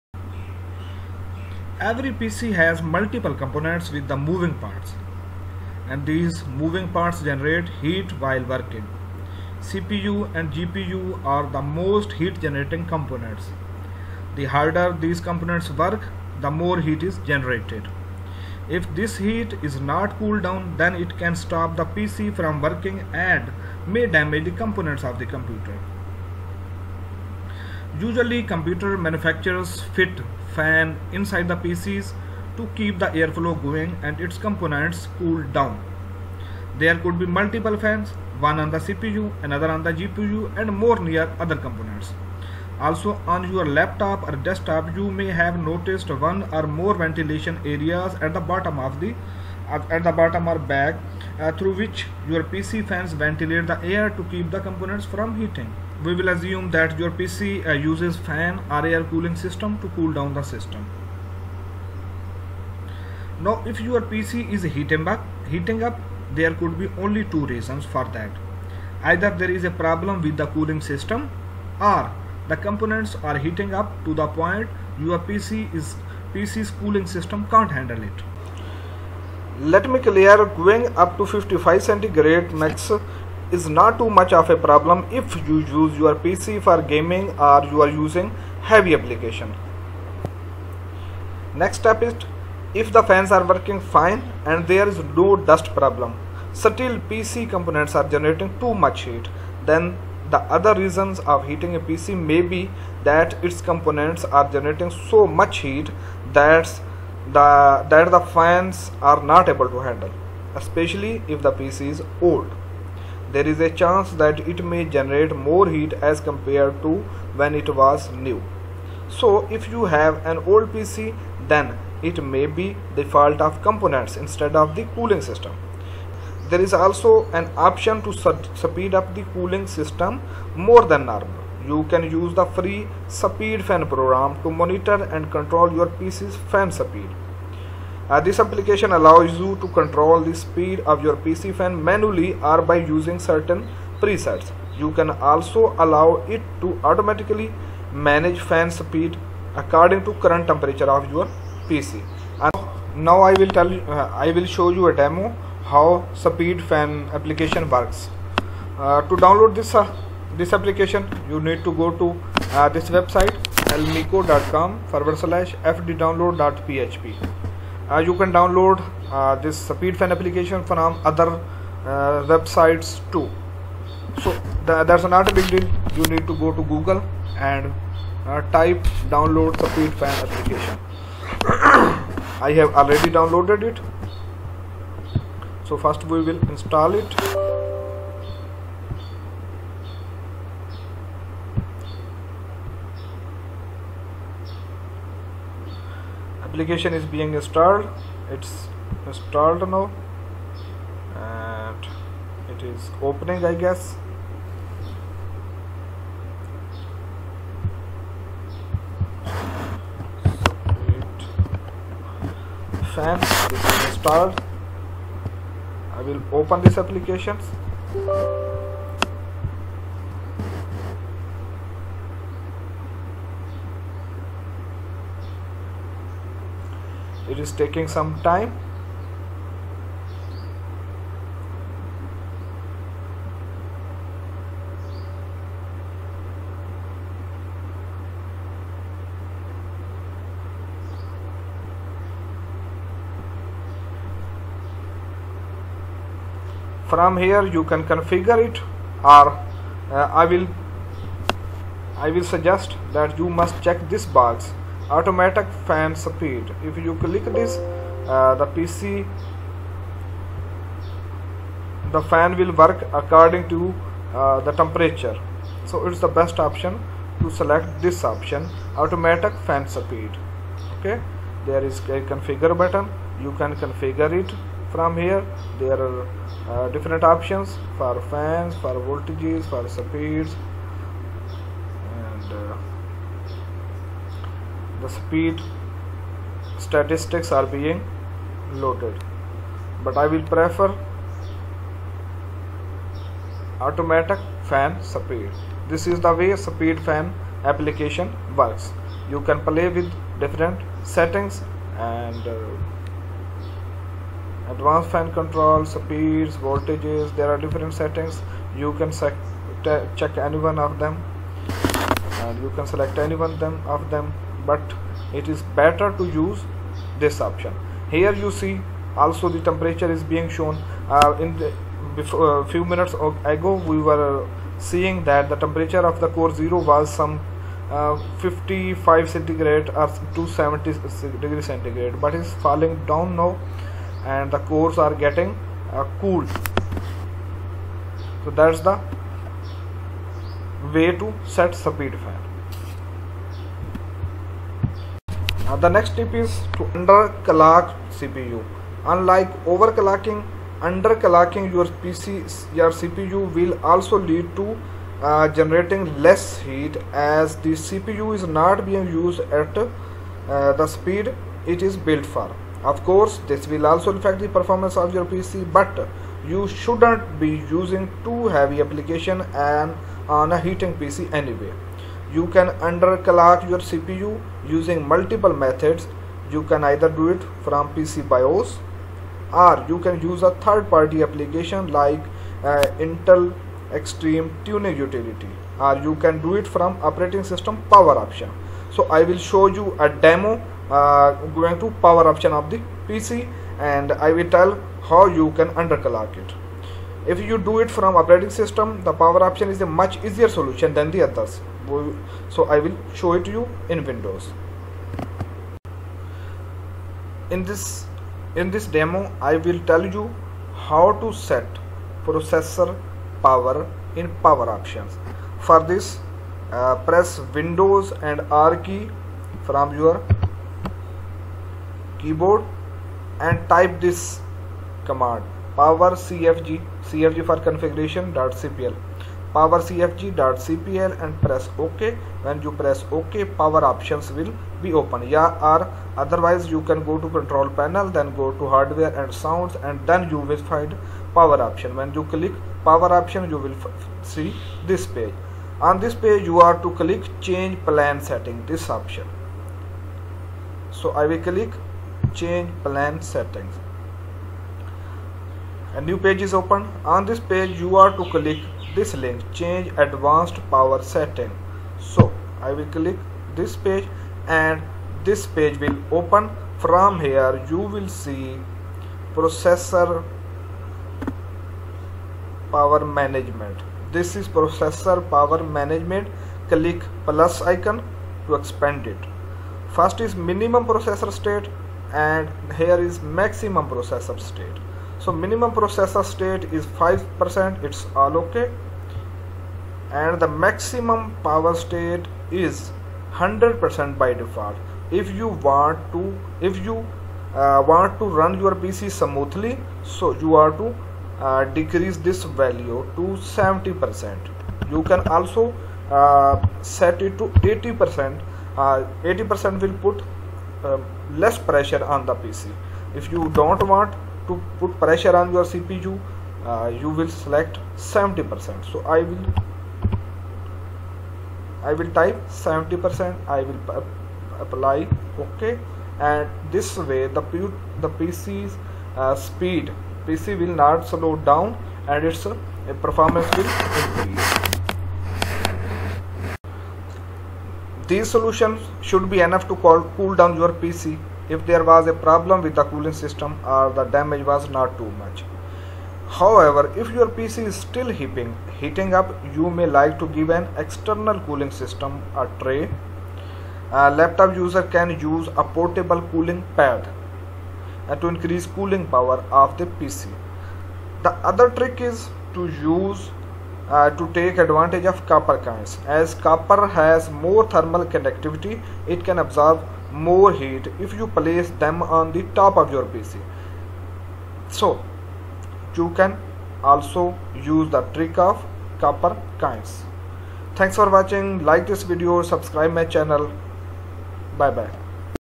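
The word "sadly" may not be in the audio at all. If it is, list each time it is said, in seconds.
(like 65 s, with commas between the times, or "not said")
not said.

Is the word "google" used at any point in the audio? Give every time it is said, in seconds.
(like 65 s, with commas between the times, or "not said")
176 s.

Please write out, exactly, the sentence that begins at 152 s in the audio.
And now I will tell uh, I will show you a demo how speed fan application works.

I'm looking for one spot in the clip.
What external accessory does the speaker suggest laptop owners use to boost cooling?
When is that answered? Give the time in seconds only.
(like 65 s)
555 s.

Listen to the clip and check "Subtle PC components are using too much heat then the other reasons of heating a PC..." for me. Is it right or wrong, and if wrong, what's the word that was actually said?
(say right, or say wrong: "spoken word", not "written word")
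wrong: "generating", not "using".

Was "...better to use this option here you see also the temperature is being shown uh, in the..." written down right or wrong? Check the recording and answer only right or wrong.
right.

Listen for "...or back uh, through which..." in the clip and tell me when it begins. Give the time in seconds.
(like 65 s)
50 s.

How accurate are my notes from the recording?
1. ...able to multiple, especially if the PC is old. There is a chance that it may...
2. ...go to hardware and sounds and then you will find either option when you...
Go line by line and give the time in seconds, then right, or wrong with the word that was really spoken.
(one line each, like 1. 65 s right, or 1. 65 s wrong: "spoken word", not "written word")
1. 109 s wrong: "handle", not "multiple"
2. 438 s wrong: "power", not "either".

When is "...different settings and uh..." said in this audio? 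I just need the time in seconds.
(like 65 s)
300 s.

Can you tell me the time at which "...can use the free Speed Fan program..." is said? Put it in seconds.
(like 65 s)
131 s.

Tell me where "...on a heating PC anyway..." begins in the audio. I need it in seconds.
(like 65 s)
370 s.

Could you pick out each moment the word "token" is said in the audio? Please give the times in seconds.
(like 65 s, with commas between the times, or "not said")
not said.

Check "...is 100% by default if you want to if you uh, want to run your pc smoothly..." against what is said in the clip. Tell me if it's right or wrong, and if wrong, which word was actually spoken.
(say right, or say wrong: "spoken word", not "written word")
right.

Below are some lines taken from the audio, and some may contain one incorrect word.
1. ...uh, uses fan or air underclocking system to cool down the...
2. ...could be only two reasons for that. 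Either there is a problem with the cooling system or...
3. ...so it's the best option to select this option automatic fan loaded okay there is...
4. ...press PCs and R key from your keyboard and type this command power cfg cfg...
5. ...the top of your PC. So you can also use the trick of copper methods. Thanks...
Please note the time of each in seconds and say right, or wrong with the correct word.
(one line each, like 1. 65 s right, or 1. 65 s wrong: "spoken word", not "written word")
1. 57 s wrong: "cooling", not "underclocking"
2. 66 s right
3. 265 s wrong: "speed", not "loaded"
4. 416 s wrong: "Windows", not "PCs"
5. 572 s wrong: "kinds", not "methods".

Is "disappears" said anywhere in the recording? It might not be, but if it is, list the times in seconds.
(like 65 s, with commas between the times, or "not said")
not said.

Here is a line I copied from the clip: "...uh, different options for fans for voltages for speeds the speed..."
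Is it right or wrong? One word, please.
right.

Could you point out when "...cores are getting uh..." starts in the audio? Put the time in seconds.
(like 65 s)
334 s.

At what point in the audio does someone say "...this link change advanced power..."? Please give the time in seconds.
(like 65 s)
458 s.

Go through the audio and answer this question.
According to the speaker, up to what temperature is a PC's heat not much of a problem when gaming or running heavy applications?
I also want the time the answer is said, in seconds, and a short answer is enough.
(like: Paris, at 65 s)
55 centigrade, at 81 s.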